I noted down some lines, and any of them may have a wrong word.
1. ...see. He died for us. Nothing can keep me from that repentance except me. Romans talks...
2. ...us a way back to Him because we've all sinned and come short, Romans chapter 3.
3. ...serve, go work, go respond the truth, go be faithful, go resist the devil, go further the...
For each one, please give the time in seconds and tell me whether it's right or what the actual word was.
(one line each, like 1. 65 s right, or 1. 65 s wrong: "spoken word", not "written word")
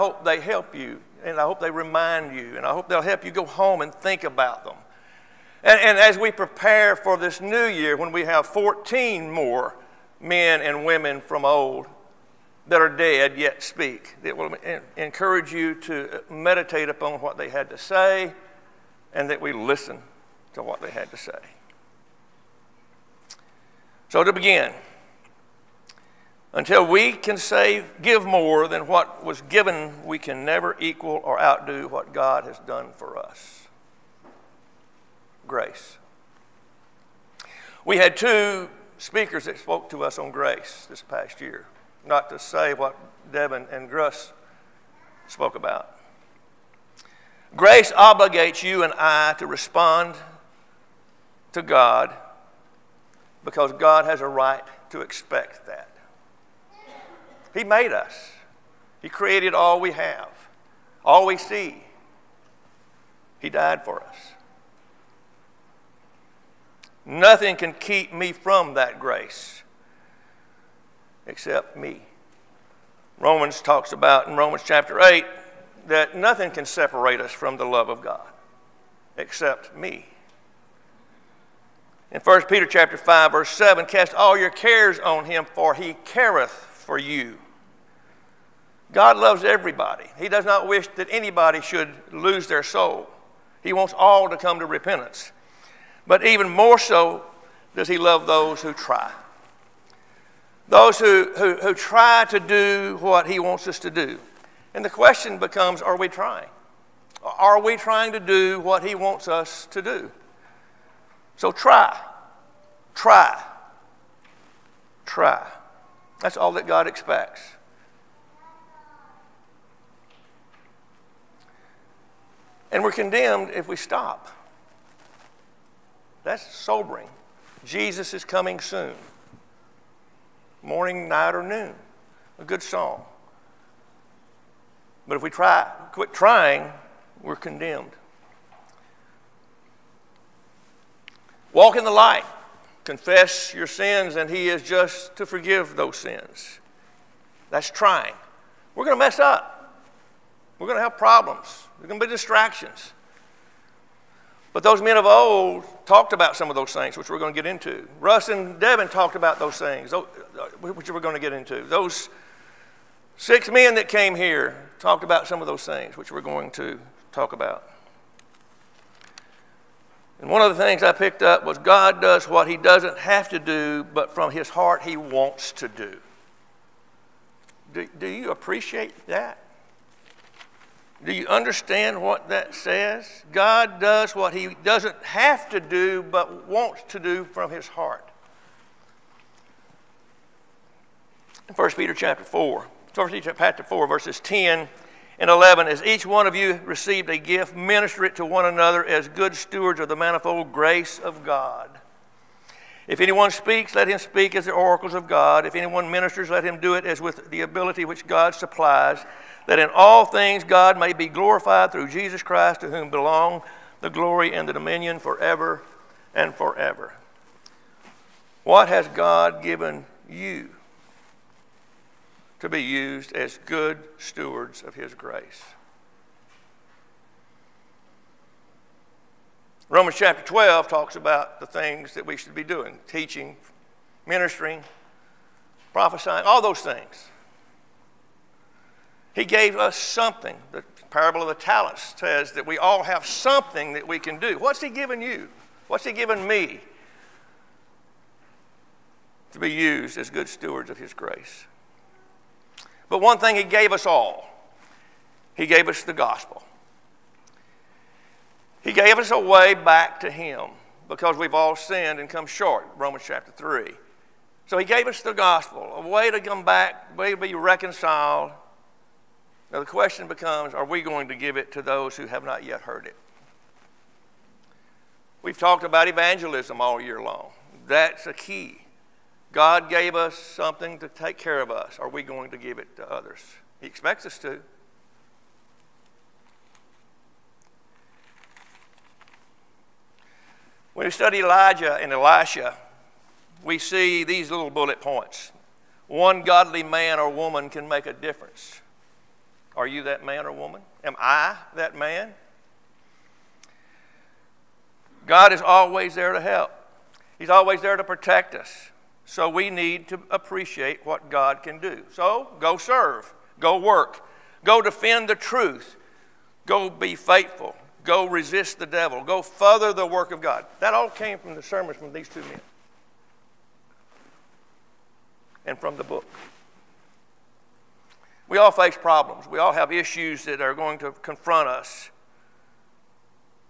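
1. 61 s wrong: "grace", not "repentance"
2. 258 s right
3. 312 s wrong: "defend", not "respond".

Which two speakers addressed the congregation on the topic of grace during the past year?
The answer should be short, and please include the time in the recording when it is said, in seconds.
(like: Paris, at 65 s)
Devin and Russ, at 43 s.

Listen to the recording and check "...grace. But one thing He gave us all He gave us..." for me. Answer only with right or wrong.
right.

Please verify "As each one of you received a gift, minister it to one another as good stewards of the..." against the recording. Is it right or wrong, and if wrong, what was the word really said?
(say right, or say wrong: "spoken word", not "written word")
right.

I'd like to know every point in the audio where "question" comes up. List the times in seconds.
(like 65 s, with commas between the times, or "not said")
104 s, 269 s.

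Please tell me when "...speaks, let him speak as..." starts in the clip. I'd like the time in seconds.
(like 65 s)
203 s.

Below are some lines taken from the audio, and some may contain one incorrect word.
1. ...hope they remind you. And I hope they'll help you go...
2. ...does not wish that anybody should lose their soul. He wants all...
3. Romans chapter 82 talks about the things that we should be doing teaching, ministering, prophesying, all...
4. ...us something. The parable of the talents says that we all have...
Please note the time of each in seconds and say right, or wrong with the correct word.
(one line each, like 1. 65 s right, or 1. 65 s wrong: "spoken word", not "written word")
1. 1 s right
2. 90 s right
3. 229 s wrong: "12", not "82"
4. 239 s right.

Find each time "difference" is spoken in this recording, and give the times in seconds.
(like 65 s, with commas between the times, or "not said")
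297 s.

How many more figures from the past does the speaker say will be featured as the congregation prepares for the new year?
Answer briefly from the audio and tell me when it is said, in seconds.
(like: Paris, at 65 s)
14, at 8 s.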